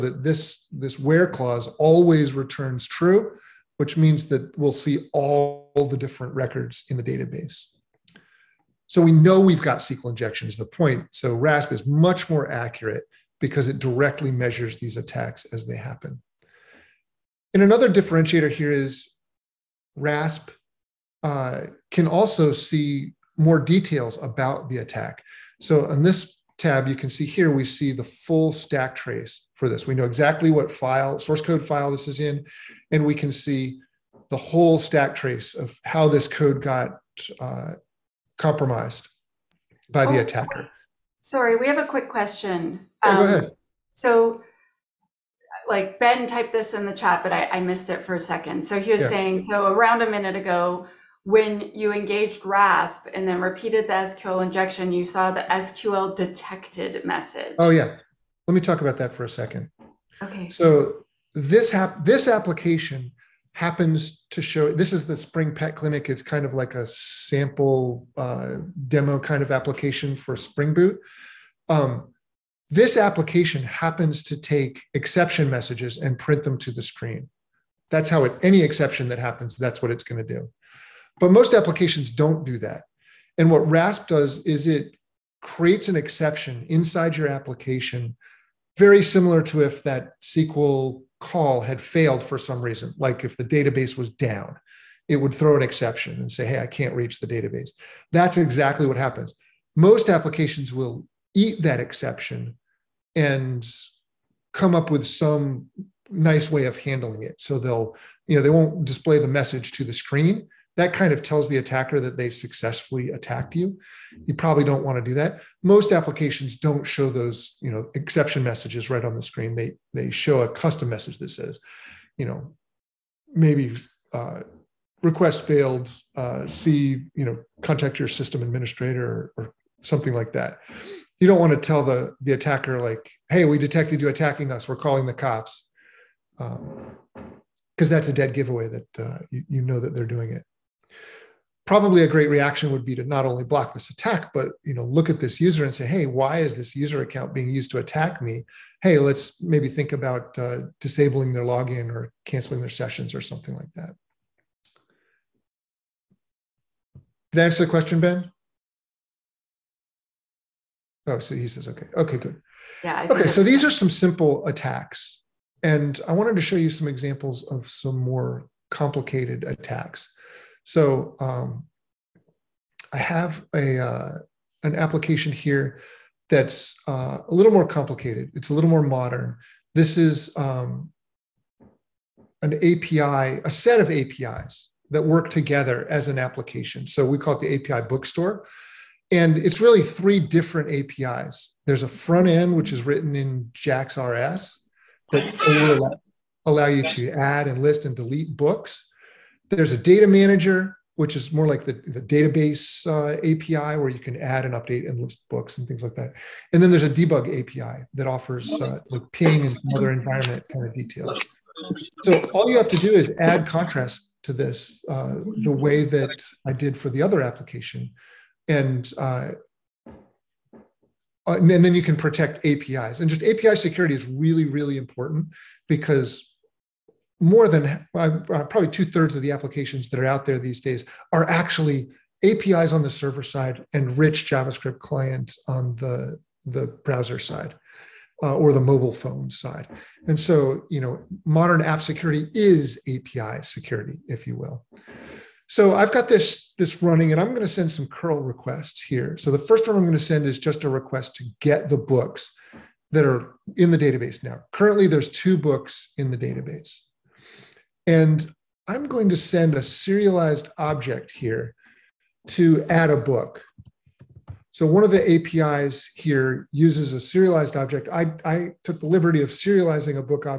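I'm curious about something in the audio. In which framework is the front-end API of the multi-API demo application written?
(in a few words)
JAX RS.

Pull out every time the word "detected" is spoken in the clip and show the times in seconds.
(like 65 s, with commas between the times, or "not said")
56 s, 133 s.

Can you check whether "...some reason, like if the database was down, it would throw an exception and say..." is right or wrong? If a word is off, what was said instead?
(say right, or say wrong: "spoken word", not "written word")
right.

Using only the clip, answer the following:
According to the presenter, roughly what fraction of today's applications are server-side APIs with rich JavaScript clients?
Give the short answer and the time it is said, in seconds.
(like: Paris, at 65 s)
two thirds, at 228 s.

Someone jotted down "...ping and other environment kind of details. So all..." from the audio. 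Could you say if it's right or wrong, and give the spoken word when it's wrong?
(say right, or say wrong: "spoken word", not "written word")
right.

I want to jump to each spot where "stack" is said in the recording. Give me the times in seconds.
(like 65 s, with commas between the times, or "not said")
28 s, 34 s.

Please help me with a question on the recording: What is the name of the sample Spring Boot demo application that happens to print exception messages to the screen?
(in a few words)
Spring Pet Clinic.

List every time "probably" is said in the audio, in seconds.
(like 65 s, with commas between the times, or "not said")
114 s, 141 s, 228 s.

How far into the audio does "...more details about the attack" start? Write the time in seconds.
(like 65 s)
23 s.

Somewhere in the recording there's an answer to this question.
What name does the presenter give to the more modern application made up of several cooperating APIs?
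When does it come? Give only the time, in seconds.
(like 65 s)
187 s.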